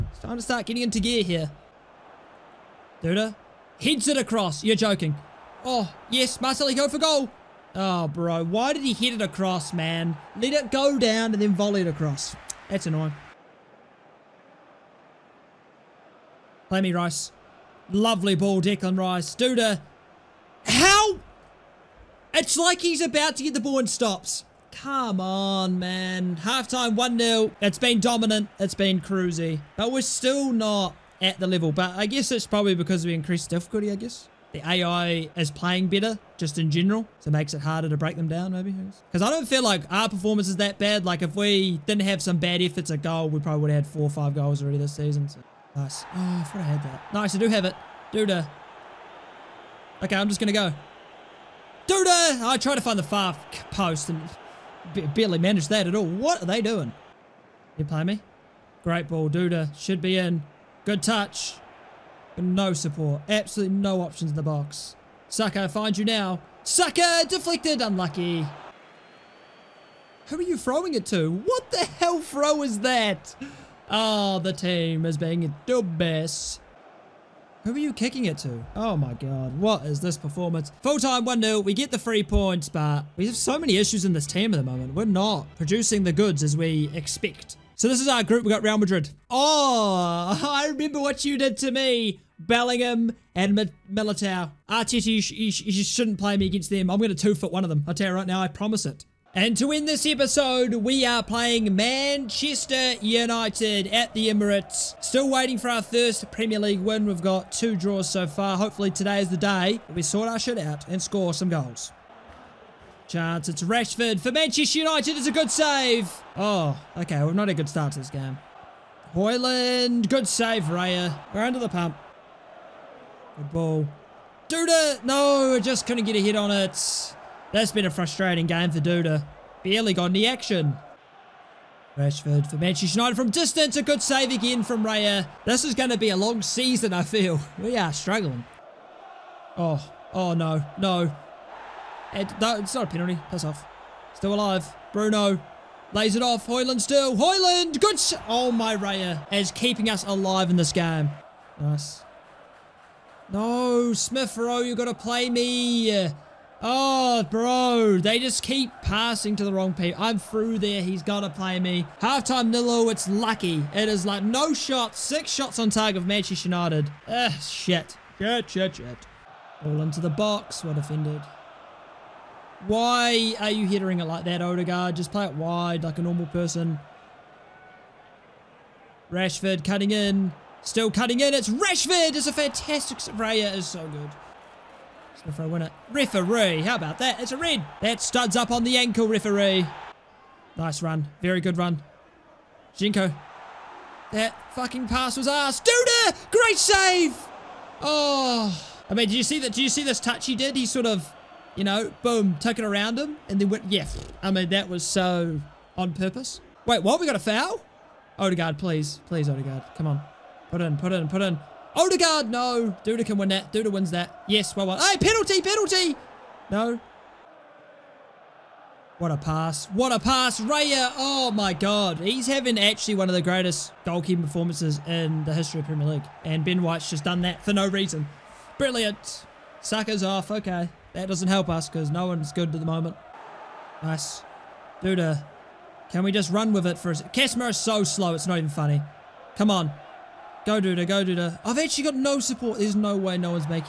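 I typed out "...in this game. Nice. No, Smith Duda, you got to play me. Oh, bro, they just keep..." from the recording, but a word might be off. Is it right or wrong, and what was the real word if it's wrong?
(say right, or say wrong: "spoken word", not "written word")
wrong: "Rowe", not "Duda".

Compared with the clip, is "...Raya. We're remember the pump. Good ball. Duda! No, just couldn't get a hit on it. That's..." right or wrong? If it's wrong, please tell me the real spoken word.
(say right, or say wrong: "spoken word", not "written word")
wrong: "under", not "remember".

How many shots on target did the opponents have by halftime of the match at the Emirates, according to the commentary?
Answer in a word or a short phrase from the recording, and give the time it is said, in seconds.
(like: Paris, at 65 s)
6, at 164 s.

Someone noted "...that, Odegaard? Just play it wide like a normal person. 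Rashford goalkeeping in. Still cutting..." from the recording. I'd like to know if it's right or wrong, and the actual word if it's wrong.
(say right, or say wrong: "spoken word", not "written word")
wrong: "cutting", not "goalkeeping".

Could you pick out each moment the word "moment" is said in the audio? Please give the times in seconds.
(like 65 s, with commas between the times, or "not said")
84 s, 232 s.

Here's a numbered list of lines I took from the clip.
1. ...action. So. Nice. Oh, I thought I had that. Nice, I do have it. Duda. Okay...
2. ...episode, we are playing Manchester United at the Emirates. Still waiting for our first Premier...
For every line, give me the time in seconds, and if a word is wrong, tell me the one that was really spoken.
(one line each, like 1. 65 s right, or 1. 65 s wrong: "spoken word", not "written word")
1. 44 s wrong: "season", not "action"
2. 100 s right.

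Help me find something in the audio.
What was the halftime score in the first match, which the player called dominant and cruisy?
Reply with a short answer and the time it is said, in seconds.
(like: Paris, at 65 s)
1-0, at 26 s.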